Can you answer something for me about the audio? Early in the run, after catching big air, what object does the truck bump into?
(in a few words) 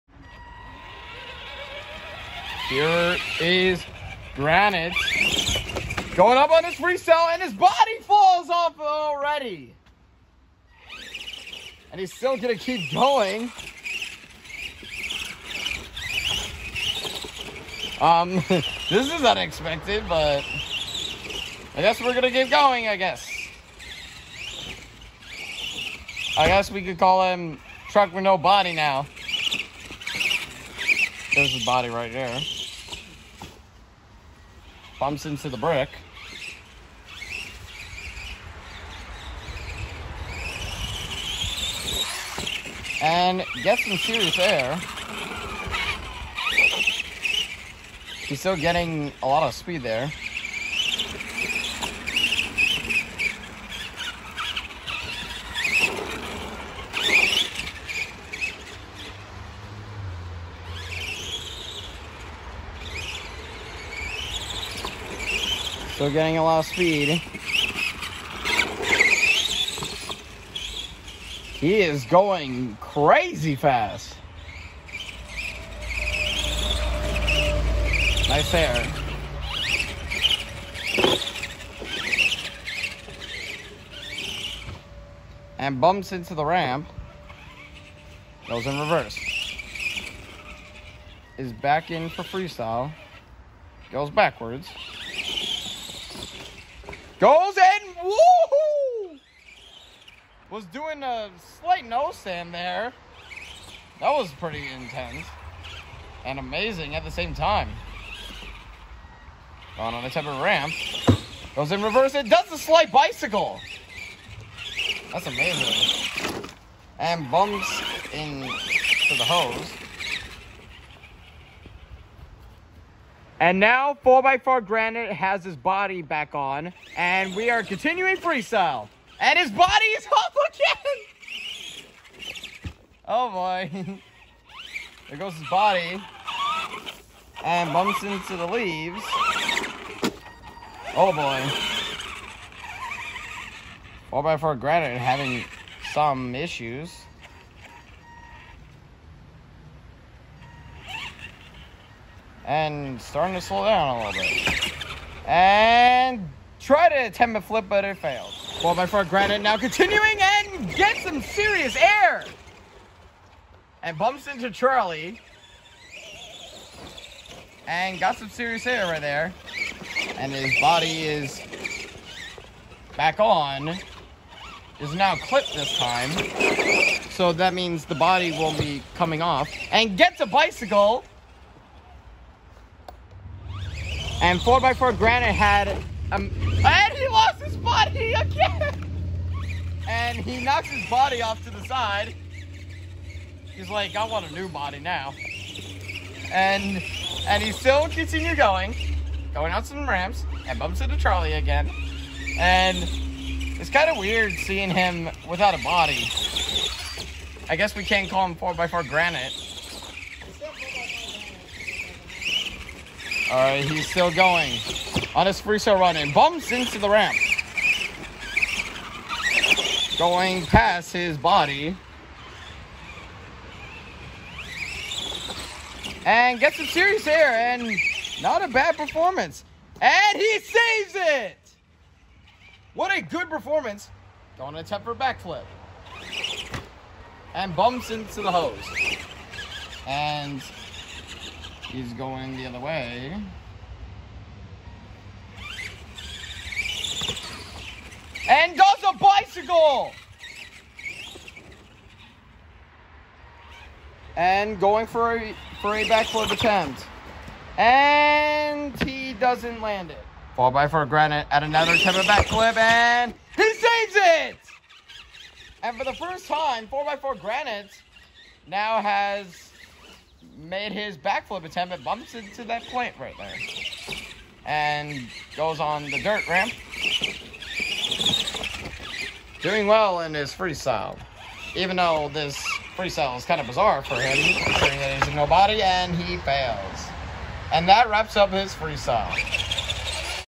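the brick.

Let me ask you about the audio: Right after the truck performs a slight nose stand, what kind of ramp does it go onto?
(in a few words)
temper ramp.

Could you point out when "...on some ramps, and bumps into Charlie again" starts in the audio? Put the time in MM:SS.
03:19.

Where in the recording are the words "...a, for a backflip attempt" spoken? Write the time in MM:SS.
04:15.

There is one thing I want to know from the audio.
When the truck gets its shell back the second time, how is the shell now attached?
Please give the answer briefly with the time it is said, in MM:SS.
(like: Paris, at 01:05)
clipped, at 02:55.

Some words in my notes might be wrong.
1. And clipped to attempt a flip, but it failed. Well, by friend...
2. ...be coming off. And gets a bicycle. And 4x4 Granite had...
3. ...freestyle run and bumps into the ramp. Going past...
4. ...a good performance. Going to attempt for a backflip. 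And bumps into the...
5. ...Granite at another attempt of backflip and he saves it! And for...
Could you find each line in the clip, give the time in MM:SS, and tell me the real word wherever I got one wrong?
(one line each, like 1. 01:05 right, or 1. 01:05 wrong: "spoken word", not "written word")
1. 02:35 wrong: "tried", not "clipped"
2. 02:58 right
3. 03:35 right
4. 03:52 right
5. 04:20 right.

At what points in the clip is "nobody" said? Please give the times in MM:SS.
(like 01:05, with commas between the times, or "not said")
04:45.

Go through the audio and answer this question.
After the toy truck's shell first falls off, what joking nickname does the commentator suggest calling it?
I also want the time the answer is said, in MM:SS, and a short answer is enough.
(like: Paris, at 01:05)
Truck with No Body, at 00:27.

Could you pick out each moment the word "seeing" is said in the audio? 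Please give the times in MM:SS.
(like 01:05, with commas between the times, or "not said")
03:24.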